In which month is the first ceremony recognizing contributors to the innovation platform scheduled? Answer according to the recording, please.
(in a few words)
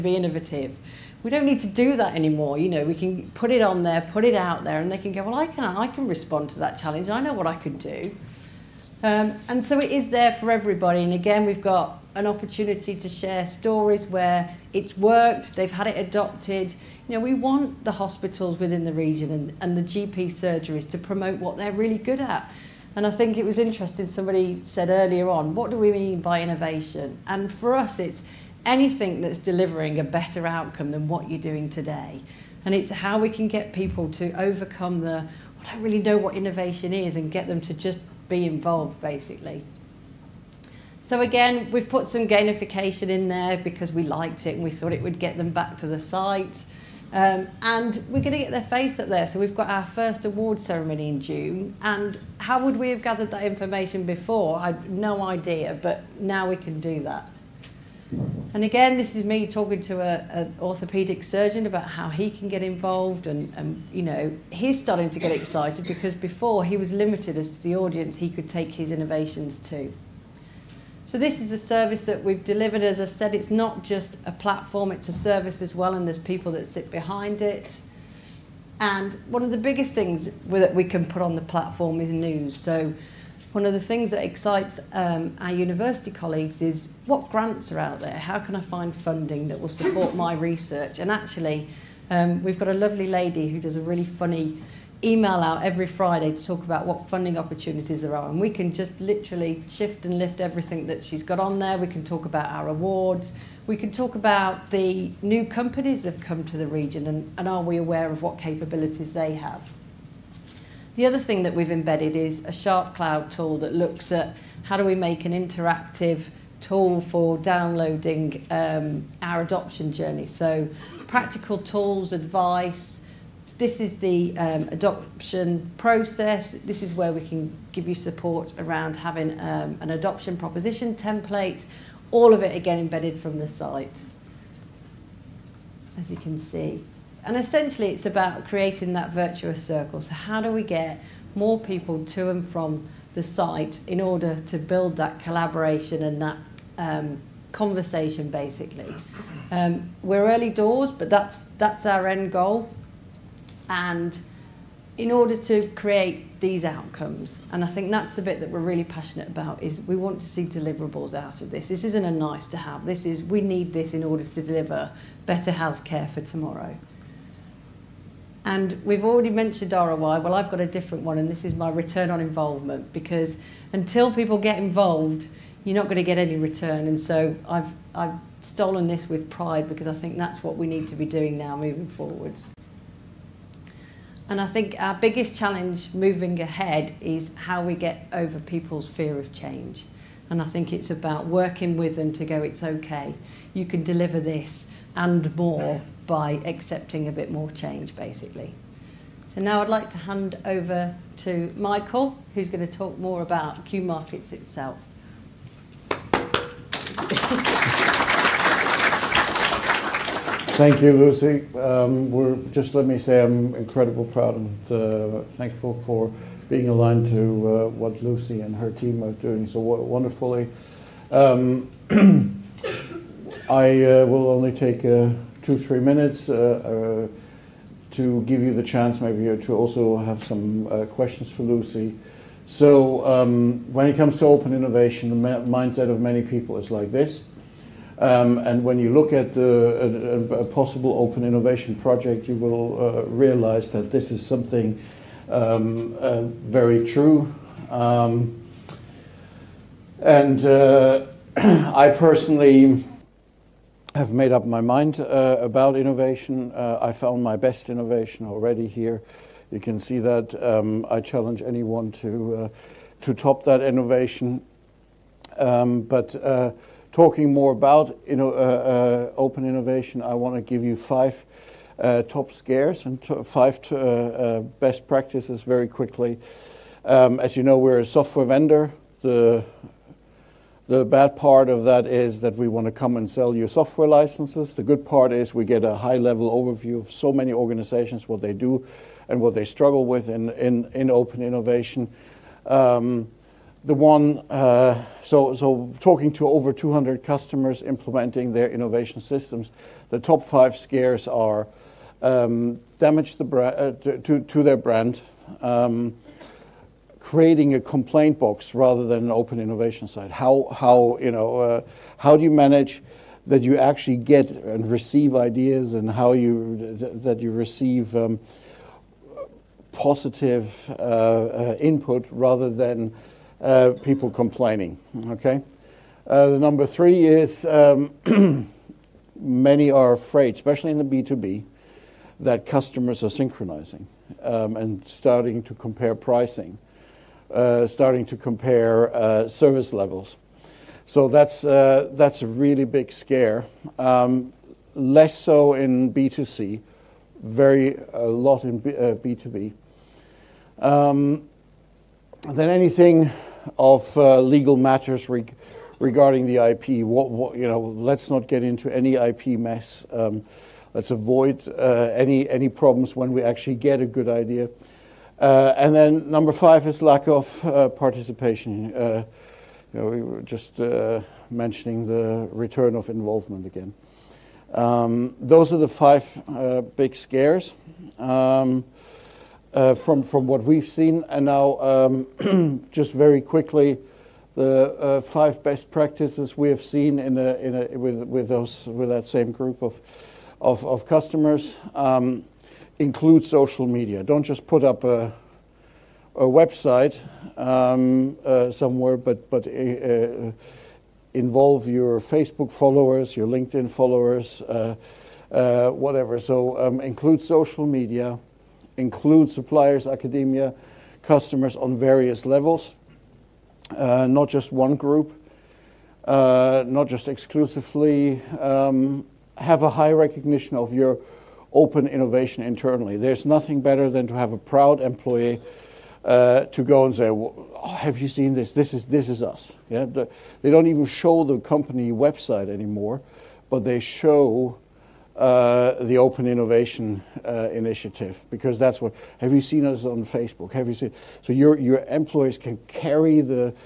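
June.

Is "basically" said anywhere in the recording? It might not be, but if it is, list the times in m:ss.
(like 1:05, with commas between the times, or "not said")
0:39, 2:28, 3:17.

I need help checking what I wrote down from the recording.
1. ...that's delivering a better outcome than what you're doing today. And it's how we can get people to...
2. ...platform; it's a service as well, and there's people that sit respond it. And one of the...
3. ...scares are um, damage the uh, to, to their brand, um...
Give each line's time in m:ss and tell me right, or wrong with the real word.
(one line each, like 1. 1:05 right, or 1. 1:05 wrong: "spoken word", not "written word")
1. 0:29 right
2. 1:14 wrong: "behind", not "respond"
3. 5:00 right.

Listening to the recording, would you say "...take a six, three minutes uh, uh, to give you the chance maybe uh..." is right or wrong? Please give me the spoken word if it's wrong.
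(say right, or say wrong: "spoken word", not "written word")
wrong: "two", not "six".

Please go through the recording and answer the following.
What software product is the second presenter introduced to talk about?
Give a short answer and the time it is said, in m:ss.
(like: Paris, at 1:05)
Q Markets, at 3:23.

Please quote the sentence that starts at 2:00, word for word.
So practical tools, advice, this is the um, adoption process.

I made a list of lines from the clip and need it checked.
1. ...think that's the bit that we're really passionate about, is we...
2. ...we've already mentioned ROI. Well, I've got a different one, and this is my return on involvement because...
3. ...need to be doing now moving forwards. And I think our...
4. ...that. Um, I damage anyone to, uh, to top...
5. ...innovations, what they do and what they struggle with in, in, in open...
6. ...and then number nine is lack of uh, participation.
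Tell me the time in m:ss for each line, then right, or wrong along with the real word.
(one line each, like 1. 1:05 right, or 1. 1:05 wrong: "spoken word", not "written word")
1. 2:37 right
2. 2:48 right
3. 3:00 right
4. 4:19 wrong: "challenge", not "damage"
5. 4:47 wrong: "organizations", not "innovations"
6. 6:05 wrong: "five", not "nine".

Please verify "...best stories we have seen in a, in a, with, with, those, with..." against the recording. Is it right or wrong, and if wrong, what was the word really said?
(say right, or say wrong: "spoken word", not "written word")
wrong: "practices", not "stories".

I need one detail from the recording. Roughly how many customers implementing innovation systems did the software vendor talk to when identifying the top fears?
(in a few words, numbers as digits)
Over 200.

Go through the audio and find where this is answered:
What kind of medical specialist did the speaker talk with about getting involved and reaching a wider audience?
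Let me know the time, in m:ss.
1:00.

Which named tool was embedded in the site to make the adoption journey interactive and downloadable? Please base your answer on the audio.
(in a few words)
SharpCloud.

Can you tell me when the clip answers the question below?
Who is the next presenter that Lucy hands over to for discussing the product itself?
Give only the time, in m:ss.
3:21.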